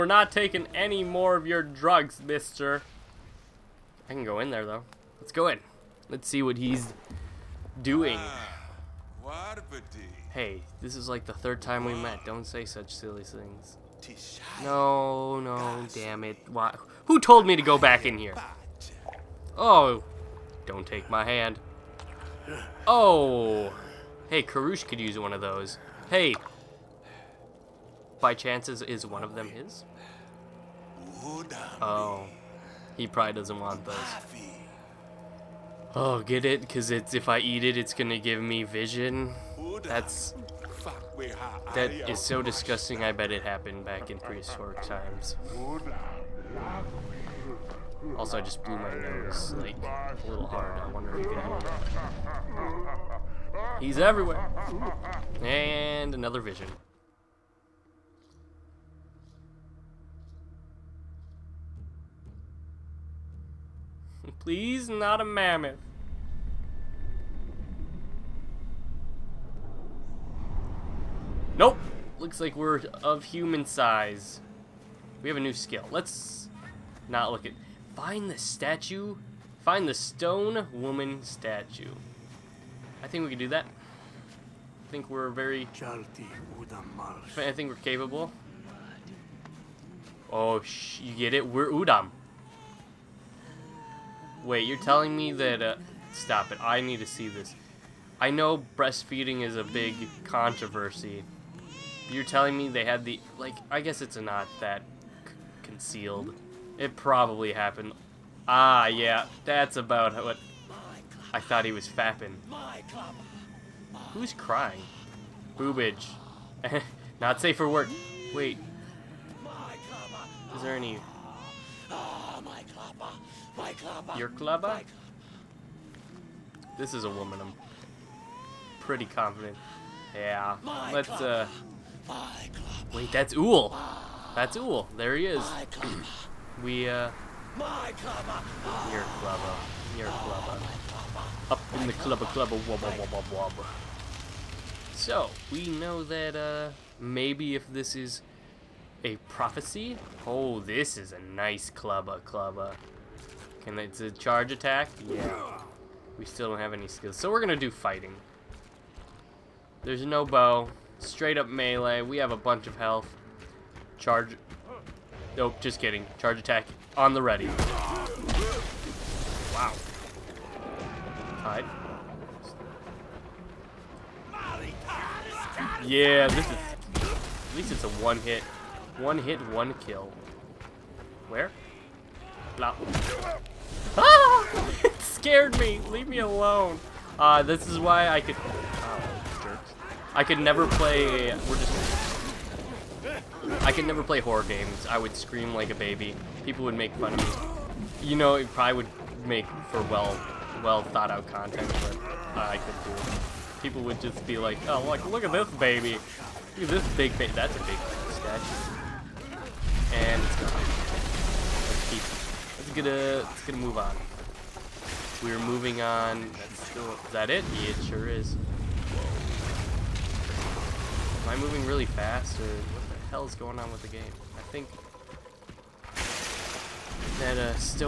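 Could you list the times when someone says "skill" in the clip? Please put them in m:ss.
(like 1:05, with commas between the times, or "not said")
1:15, 2:36.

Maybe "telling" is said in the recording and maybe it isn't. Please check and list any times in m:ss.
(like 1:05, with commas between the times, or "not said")
1:34, 1:42.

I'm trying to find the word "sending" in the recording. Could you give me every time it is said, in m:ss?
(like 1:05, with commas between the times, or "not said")
not said.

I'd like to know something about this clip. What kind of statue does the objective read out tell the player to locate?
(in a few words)
stone woman statue.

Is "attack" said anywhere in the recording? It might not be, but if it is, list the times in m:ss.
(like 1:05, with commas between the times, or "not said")
2:34, 2:46.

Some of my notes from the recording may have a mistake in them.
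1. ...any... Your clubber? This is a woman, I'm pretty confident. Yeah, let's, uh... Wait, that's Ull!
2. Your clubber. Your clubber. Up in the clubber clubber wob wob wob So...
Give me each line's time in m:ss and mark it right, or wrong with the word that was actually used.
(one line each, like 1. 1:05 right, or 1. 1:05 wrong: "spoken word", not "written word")
1. 2:00 right
2. 2:17 right.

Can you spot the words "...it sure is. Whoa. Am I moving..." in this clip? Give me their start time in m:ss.
3:37.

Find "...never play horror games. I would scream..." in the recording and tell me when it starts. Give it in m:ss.
3:13.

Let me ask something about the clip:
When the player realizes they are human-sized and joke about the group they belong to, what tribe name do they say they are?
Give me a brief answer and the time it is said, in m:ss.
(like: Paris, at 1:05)
Udam, at 1:31.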